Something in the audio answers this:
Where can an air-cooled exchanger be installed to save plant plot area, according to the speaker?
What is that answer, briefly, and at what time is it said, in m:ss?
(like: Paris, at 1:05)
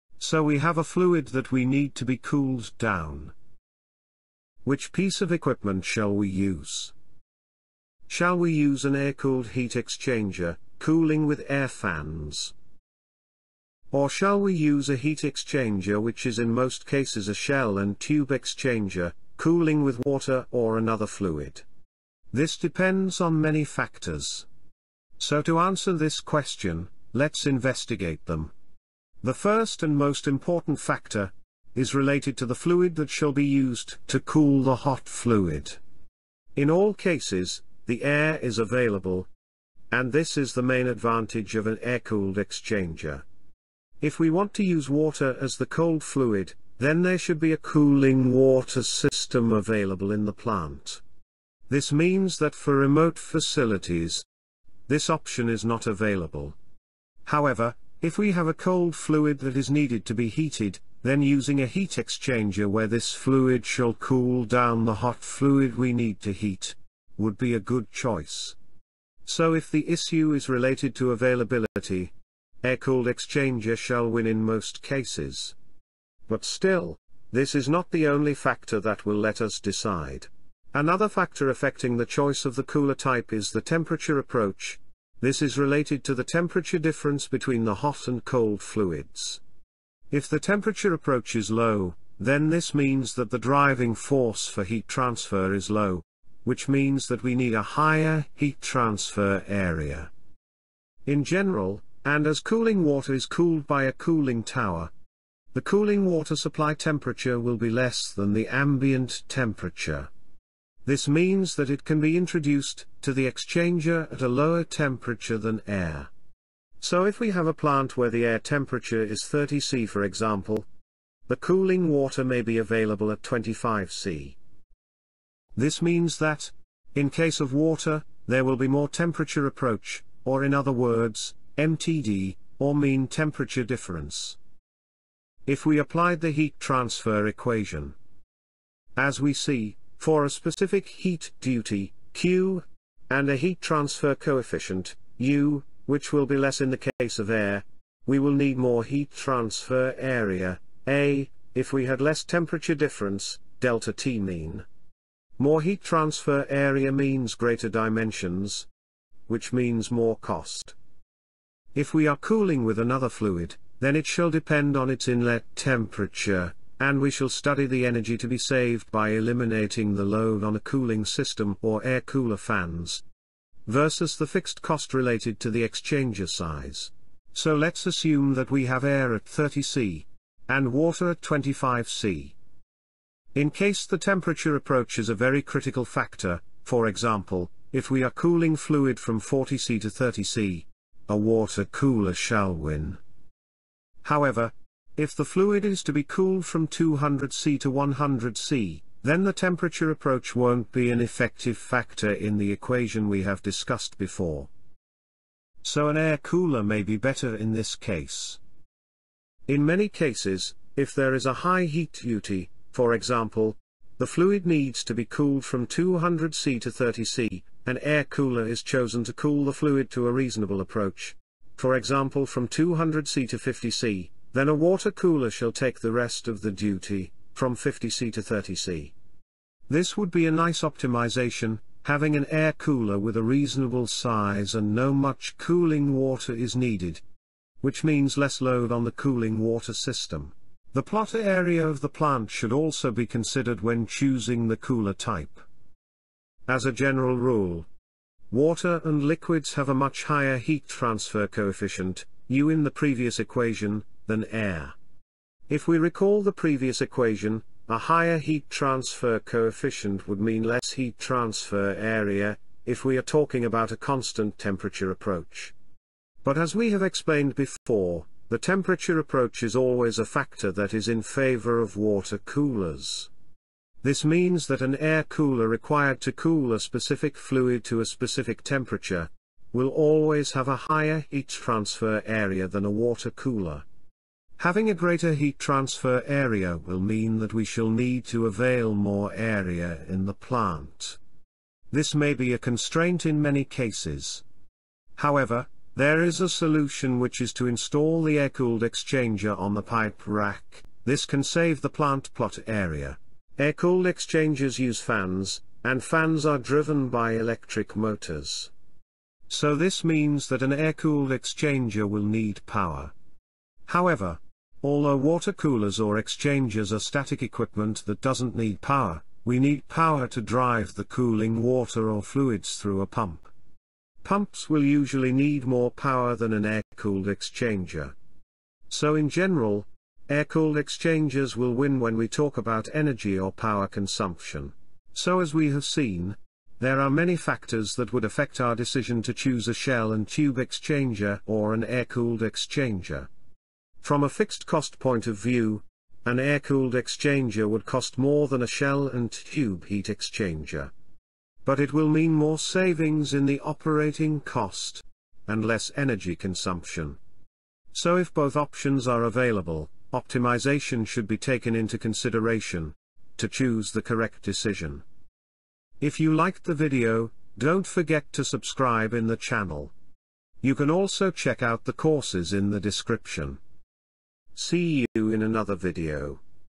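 On the pipe rack, at 4:59.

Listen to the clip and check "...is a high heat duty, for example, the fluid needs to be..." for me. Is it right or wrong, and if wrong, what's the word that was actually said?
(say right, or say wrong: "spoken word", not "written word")
right.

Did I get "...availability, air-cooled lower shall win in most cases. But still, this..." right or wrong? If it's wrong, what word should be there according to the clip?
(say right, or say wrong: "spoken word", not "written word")
wrong: "exchanger", not "lower".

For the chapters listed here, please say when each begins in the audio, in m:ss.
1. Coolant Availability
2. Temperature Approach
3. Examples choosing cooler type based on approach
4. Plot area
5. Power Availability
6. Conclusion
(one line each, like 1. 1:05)
1. 0:29
2. 1:20
3. 2:56
4. 4:01
5. 5:03
6. 5:35.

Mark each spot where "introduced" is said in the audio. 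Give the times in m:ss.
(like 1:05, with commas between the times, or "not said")
1:52.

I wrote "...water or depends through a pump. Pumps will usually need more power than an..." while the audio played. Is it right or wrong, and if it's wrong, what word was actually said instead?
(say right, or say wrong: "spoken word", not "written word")
wrong: "fluids", not "depends".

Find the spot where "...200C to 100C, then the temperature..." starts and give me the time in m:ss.
3:16.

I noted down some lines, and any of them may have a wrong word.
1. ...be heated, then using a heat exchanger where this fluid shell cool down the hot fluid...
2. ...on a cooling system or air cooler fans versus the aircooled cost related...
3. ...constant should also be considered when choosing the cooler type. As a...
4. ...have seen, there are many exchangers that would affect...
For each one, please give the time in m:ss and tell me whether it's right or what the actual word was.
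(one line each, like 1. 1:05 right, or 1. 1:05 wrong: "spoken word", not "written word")
1. 1:00 wrong: "shall", not "shell"
2. 2:50 wrong: "fixed", not "aircooled"
3. 4:01 wrong: "plant", not "constant"
4. 5:35 wrong: "factors", not "exchangers".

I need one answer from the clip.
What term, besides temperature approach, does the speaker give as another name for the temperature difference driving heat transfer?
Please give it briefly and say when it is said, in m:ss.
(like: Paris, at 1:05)
mean temperature difference, at 2:12.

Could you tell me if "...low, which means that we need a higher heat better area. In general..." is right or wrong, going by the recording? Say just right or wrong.
wrong.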